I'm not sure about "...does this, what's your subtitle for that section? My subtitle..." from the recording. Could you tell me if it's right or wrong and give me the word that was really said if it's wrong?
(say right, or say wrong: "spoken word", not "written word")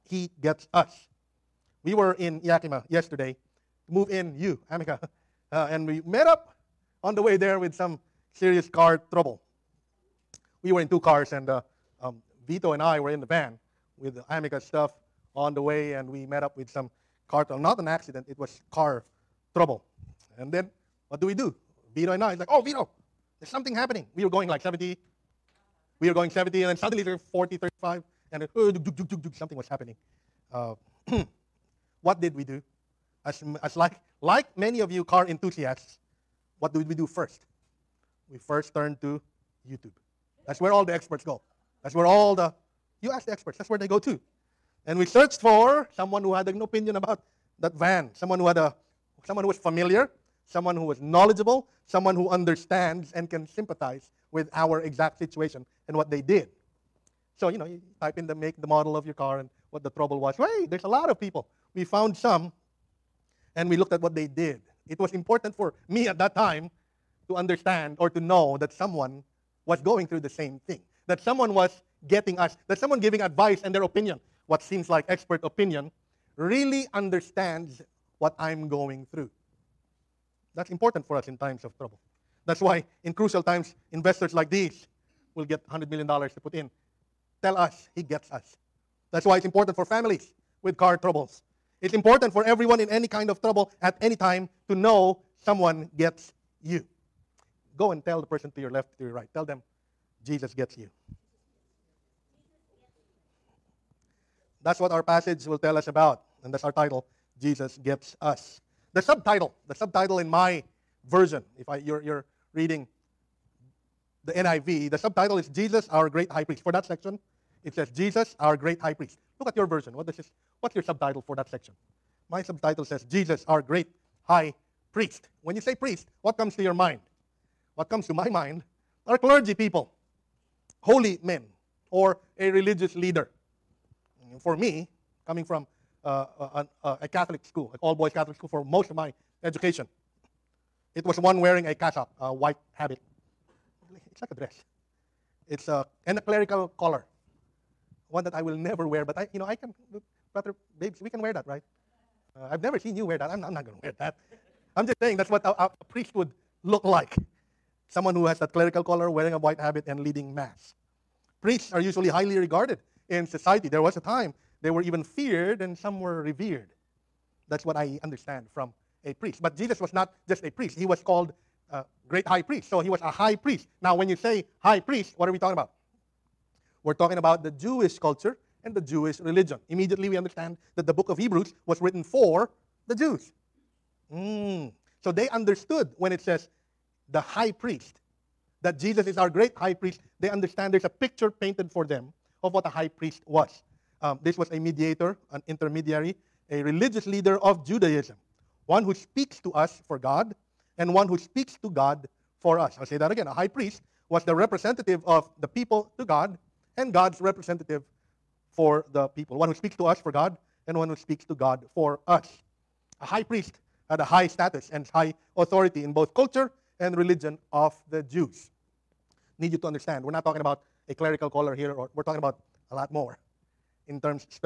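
right.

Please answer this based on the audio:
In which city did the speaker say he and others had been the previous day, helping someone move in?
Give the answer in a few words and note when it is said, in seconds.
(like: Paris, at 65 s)
Yakima, at 2 s.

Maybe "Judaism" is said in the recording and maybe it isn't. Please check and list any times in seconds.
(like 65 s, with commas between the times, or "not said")
197 s.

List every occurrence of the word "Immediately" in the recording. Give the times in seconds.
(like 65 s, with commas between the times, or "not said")
179 s.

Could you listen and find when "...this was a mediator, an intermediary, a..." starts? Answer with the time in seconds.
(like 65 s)
194 s.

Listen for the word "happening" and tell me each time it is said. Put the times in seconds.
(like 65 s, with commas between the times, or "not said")
23 s, 29 s.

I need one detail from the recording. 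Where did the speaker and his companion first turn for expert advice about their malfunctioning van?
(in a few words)
YouTube.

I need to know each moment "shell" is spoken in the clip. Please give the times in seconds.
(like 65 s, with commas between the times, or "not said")
not said.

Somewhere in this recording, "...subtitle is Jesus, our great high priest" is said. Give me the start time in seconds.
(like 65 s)
114 s.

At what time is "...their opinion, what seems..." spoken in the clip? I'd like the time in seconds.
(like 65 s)
73 s.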